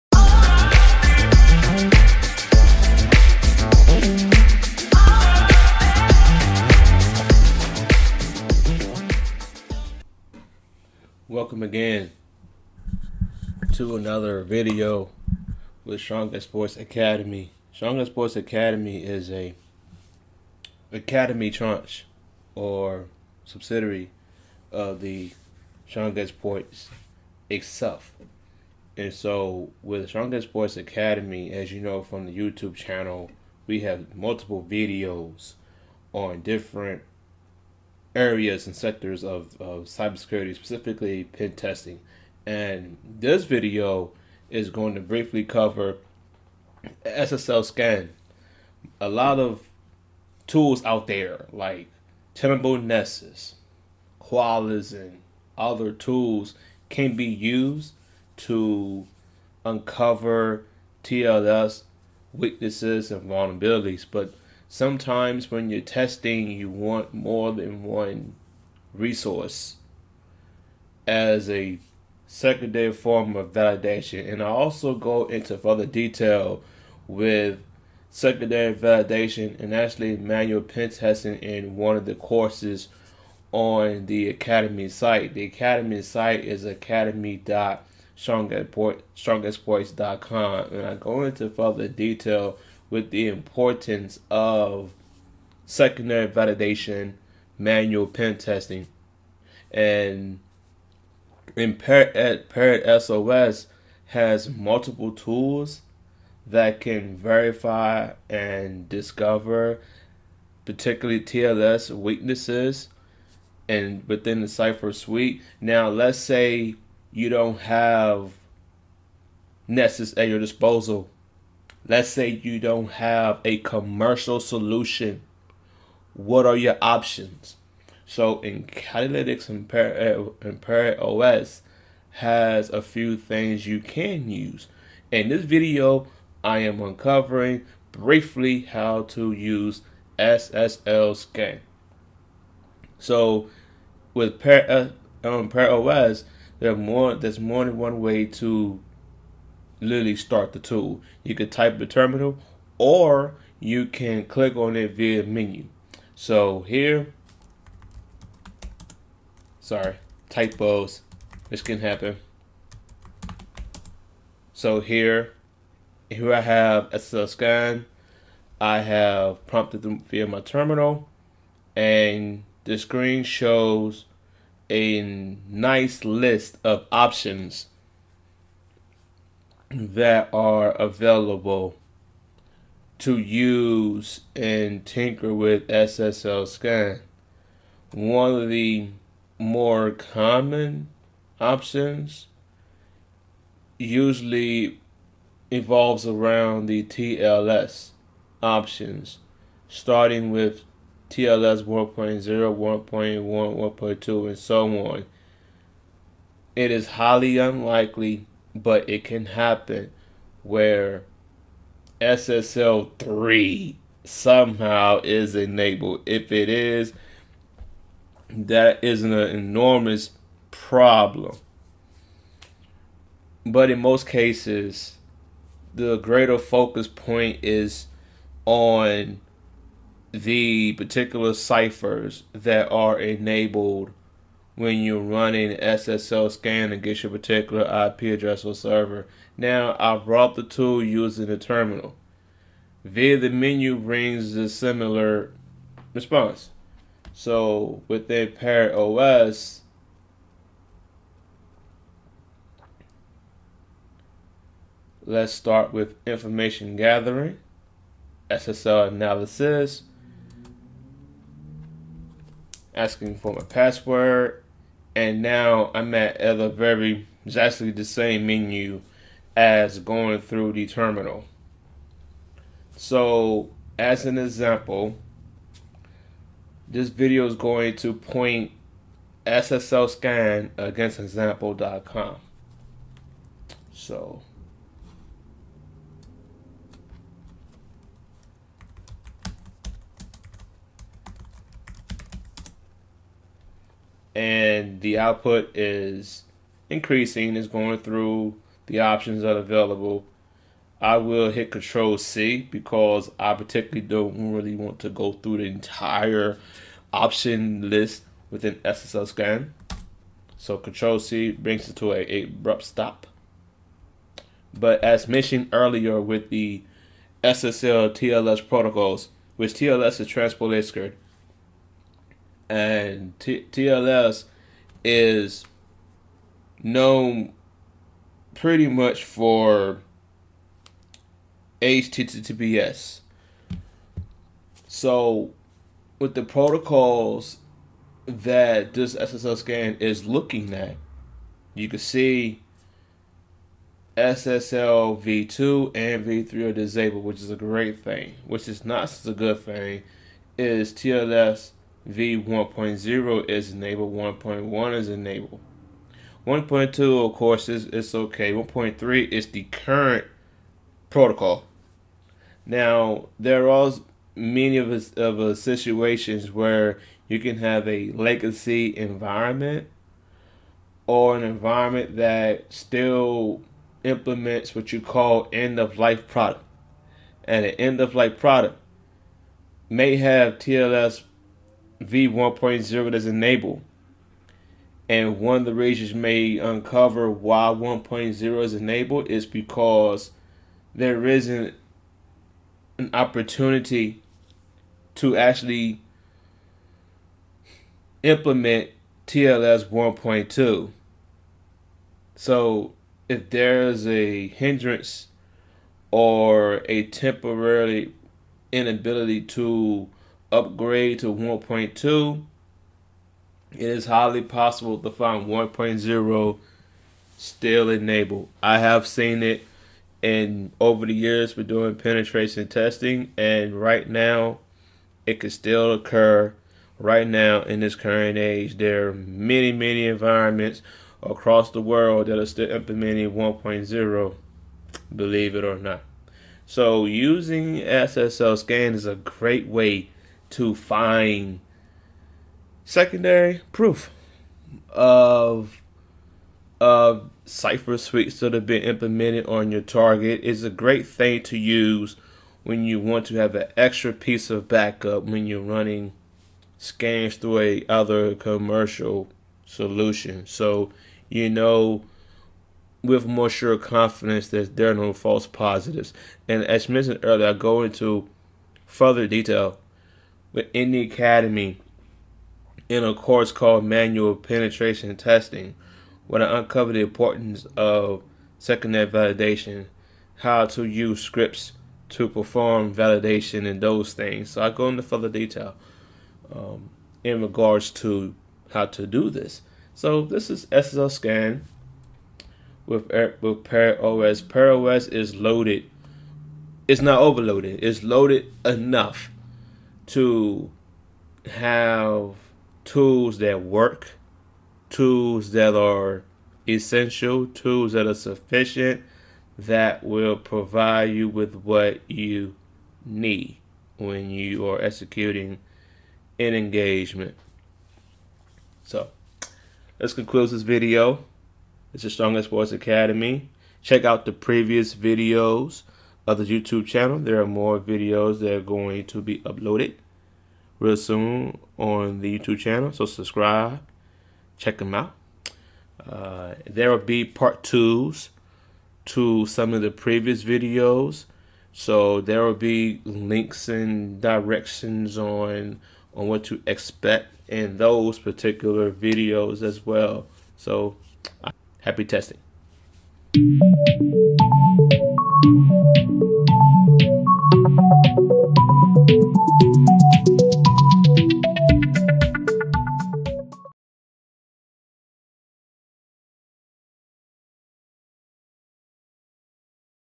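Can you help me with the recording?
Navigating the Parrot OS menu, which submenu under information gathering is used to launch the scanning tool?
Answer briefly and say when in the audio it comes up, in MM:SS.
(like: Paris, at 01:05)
SSL analysis, at 04:18.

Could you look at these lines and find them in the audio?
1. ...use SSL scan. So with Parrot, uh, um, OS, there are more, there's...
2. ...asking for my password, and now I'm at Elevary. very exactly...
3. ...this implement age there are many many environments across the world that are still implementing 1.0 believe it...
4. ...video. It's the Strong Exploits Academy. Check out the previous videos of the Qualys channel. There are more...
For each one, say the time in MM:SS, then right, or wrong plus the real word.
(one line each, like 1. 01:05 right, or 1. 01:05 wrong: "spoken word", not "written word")
1. 02:19 right
2. 04:22 right
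3. 07:07 wrong: "current", not "implement"
4. 08:40 wrong: "YouTube", not "Qualys".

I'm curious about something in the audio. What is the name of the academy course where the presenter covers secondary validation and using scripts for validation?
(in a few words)
Manual Penetration Testing.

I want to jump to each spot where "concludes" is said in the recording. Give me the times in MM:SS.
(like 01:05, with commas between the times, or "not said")
08:39.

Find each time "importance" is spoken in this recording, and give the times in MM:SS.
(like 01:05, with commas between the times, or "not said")
01:33, 07:56.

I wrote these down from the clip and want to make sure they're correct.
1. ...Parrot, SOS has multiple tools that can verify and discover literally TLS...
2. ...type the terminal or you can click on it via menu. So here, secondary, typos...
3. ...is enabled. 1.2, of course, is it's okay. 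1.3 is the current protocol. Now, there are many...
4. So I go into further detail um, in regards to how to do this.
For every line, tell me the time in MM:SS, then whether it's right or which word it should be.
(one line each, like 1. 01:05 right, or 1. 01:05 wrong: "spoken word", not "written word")
1. 01:41 wrong: "particularly", not "literally"
2. 02:31 wrong: "sorry", not "secondary"
3. 05:54 right
4. 08:04 right.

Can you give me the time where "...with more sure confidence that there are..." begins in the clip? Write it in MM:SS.
07:42.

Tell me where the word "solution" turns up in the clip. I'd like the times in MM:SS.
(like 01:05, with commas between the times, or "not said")
02:04, 07:39.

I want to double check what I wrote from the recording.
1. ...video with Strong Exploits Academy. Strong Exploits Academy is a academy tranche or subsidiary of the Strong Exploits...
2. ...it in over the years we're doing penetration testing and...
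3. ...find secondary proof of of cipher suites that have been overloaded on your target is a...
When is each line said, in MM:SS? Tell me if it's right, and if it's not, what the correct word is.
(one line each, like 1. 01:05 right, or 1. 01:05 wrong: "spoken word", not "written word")
1. 00:14 right
2. 06:59 right
3. 07:20 wrong: "implemented", not "overloaded".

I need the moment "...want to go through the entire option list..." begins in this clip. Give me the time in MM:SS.
05:04.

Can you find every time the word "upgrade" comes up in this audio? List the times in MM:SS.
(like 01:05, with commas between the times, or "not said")
06:50.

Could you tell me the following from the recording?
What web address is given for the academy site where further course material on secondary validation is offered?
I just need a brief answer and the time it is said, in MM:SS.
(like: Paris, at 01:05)
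academy.strongexploits.com, at 01:26.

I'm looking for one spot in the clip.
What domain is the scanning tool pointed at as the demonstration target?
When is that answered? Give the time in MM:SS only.
04:40.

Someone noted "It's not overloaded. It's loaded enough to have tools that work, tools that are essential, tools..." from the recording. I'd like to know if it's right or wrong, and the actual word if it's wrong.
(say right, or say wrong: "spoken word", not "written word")
right.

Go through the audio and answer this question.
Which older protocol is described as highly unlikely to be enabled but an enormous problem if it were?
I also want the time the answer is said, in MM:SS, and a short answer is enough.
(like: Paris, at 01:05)
SSL 3, at 03:31.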